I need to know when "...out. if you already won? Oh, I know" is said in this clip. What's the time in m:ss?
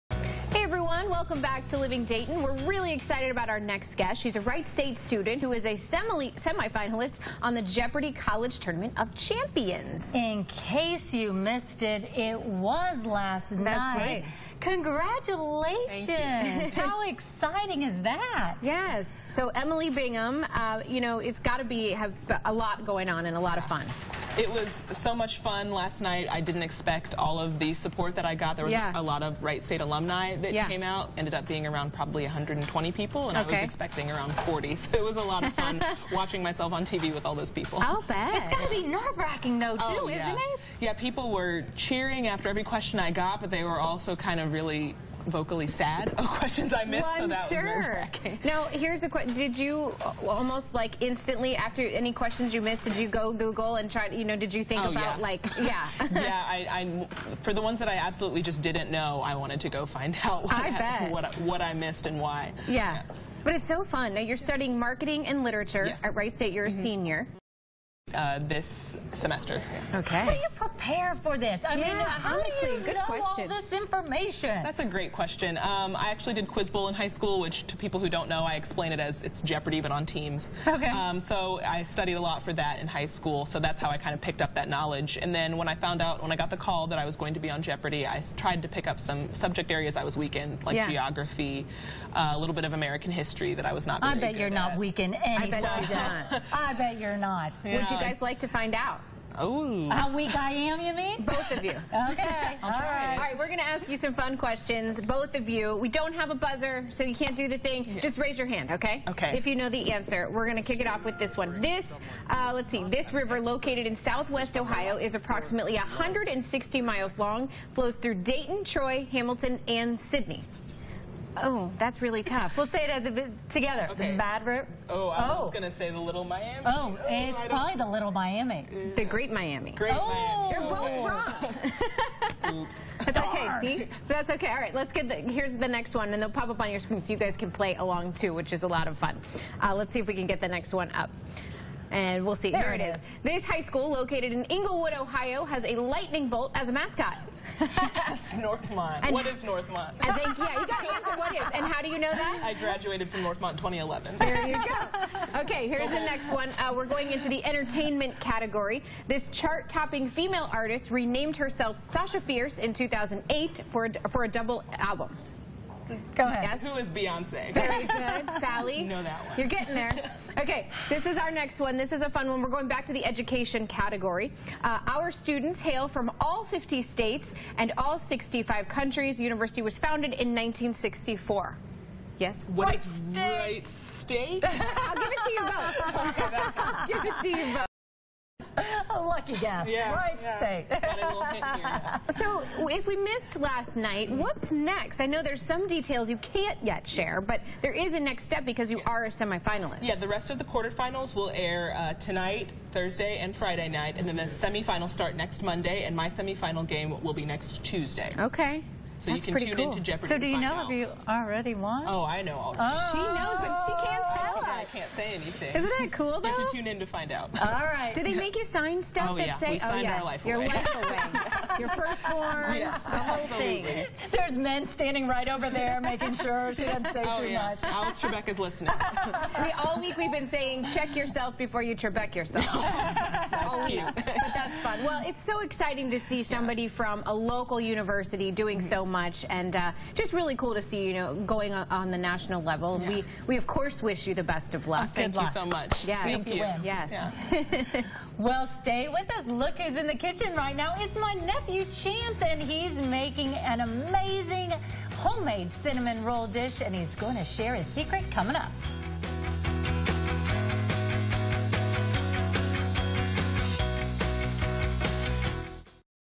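3:30.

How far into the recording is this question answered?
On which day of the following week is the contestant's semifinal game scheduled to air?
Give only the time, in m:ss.
3:27.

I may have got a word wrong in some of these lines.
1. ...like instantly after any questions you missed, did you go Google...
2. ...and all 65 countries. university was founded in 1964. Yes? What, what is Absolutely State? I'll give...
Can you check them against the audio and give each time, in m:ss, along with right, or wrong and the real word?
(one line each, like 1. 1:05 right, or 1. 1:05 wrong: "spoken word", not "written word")
1. 0:50 right
2. 2:57 wrong: "Wright", not "Absolutely".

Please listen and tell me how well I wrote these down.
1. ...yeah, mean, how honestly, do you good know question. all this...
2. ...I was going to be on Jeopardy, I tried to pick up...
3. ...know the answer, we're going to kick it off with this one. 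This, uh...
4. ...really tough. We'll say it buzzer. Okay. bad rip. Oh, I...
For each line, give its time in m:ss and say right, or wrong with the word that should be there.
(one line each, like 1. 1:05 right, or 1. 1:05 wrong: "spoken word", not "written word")
1. 1:11 right
2. 1:26 right
3. 1:49 right
4. 2:02 wrong: "together", not "buzzer".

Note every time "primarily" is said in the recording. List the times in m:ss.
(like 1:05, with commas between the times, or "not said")
not said.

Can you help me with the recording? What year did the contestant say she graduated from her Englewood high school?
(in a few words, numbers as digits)
2011.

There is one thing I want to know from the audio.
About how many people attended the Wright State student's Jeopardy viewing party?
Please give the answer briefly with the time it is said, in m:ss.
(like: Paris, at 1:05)
120, at 0:32.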